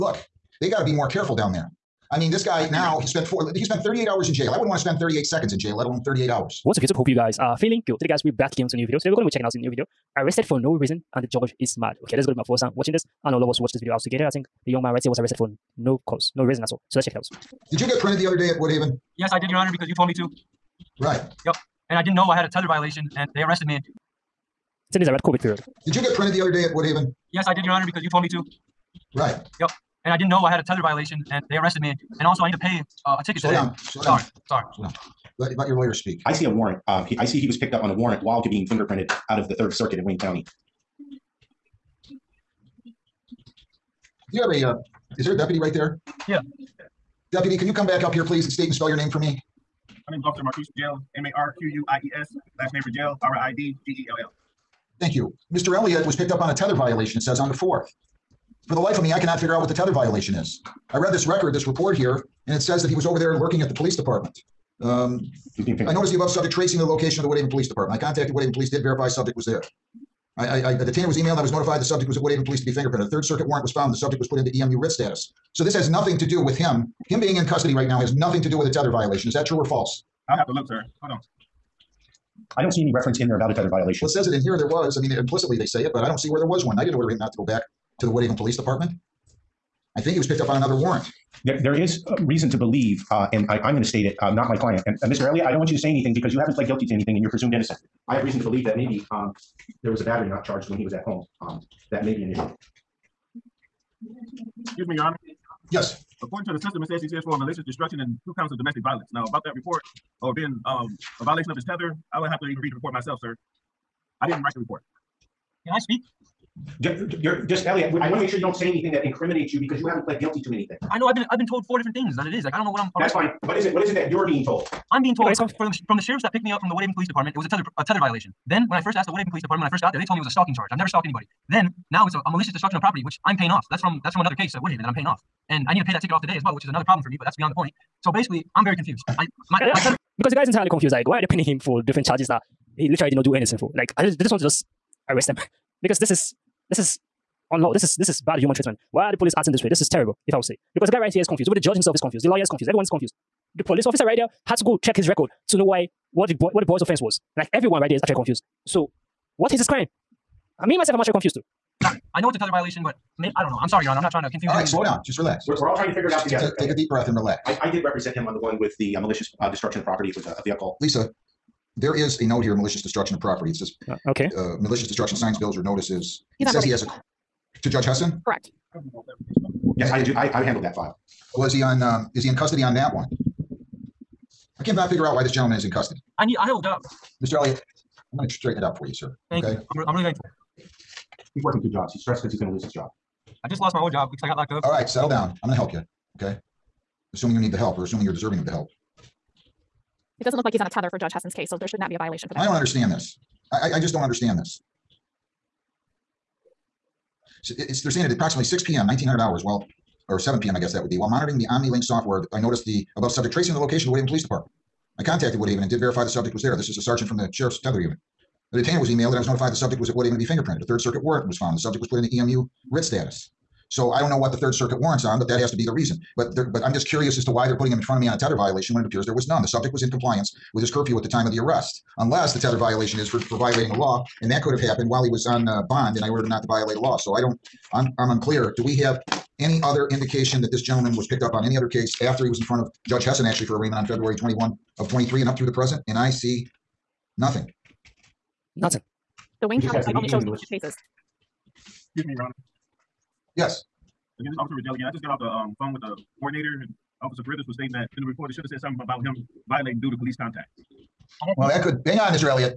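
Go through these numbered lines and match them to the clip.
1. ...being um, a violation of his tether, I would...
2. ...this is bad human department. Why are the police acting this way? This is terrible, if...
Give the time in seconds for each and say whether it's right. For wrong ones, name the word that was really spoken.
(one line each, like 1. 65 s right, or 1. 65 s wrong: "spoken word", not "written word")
1. 110 s right
2. 147 s wrong: "treatment", not "department".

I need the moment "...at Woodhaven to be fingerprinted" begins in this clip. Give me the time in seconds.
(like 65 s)
219 s.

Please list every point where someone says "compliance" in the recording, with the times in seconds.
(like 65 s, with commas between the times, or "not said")
229 s.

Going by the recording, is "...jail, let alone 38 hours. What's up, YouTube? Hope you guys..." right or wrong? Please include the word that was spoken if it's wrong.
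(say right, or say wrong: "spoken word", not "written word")
right.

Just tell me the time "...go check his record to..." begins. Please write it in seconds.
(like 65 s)
154 s.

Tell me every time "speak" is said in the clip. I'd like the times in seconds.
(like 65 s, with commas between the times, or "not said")
35 s, 115 s.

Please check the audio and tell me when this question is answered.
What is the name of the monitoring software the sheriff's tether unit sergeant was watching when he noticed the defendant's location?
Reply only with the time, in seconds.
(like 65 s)
211 s.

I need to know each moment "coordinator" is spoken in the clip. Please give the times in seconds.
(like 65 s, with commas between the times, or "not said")
256 s.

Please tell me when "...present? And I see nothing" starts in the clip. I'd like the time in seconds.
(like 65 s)
245 s.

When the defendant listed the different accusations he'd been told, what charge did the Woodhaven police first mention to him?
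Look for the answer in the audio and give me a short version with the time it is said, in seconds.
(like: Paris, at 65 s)
stalking, at 130 s.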